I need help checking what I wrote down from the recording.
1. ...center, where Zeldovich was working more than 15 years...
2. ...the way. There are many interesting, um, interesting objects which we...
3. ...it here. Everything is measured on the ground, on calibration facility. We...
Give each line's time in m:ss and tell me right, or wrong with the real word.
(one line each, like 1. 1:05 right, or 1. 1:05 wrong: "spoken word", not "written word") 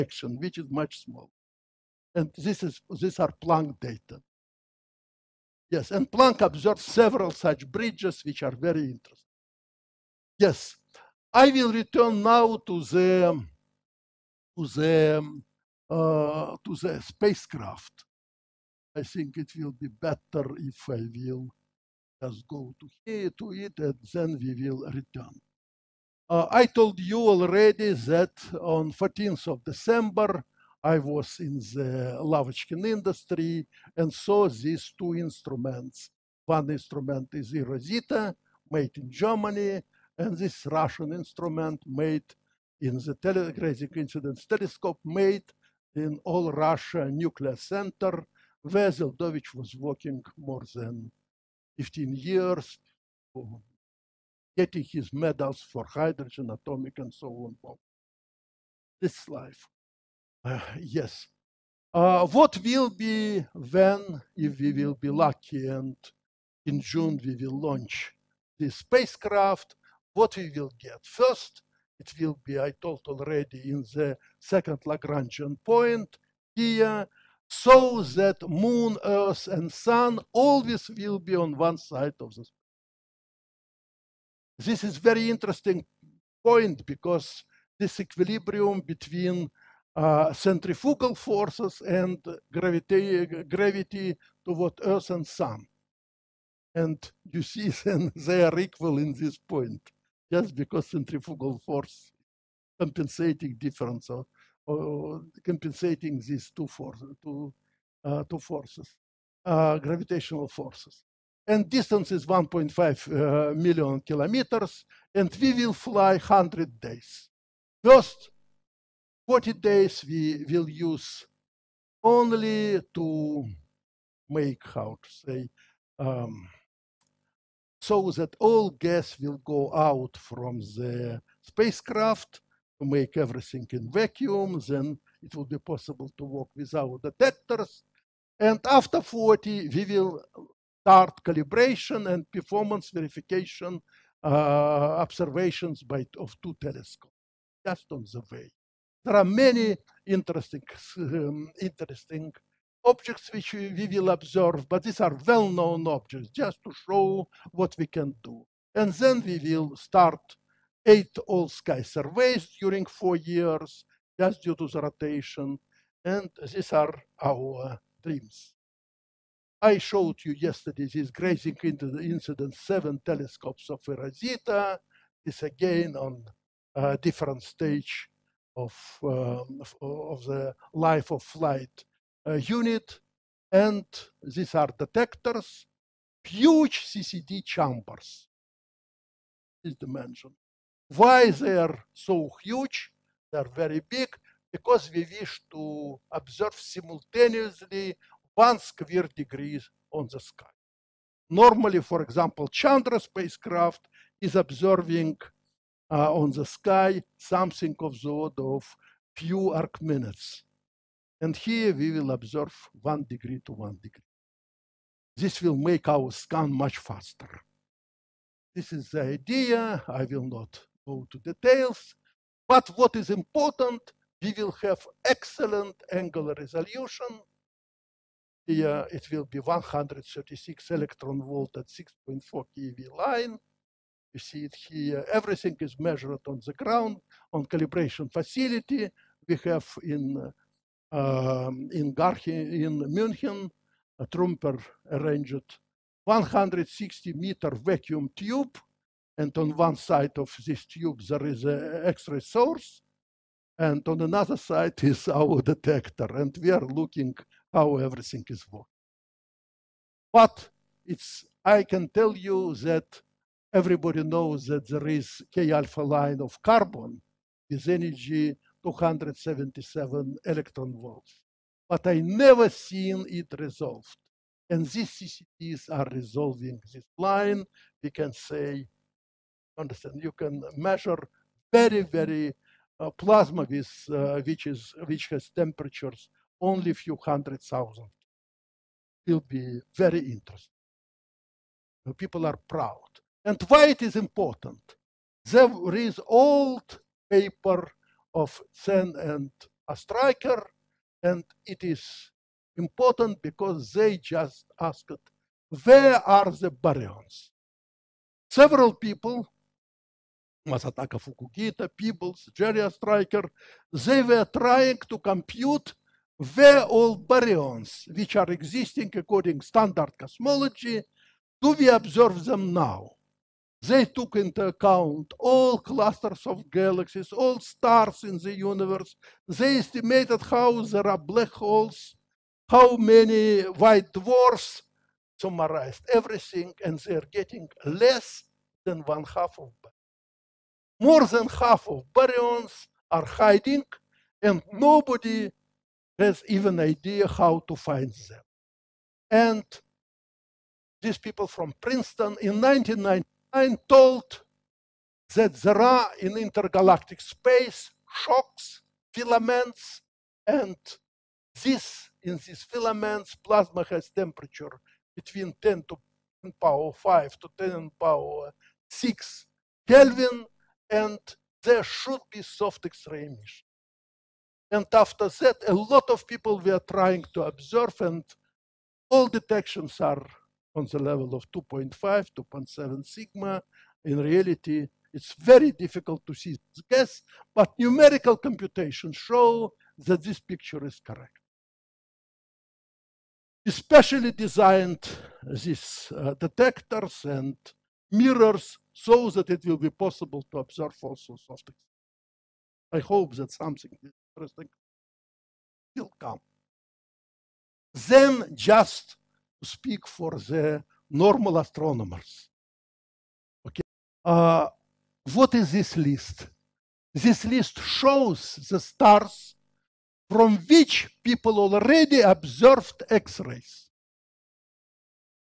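1. 0:47 right
2. 2:28 right
3. 3:54 right.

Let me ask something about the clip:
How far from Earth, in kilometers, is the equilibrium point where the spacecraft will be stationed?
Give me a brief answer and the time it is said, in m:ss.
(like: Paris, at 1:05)
1.5 million kilometers, at 1:52.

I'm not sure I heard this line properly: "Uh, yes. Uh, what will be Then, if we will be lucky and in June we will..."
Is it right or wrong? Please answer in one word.
right.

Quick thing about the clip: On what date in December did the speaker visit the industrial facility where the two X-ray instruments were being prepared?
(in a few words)
14 December.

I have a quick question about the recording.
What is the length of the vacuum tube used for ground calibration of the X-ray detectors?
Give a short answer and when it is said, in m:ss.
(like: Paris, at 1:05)
160 meters, at 4:06.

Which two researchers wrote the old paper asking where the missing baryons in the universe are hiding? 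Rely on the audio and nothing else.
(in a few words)
Cen and Ostriker.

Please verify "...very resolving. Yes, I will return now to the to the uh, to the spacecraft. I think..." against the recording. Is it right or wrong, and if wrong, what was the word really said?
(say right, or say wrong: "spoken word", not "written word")
wrong: "interesting", not "resolving".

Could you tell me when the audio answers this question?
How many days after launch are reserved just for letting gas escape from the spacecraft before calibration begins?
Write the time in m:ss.
1:59.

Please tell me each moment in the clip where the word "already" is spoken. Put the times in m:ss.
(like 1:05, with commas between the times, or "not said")
0:27, 1:13, 7:01.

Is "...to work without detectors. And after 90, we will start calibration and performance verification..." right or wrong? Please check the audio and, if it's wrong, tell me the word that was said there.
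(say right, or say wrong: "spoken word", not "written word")
wrong: "40", not "90".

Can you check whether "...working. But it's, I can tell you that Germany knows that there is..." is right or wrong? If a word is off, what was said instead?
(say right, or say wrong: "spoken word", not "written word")
wrong: "Everybody", not "Germany".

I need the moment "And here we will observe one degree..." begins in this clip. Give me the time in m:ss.
3:31.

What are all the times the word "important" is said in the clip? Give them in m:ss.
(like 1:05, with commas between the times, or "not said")
3:43, 4:53, 5:02.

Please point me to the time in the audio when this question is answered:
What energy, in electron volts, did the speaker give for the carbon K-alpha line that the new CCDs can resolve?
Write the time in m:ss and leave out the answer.
4:28.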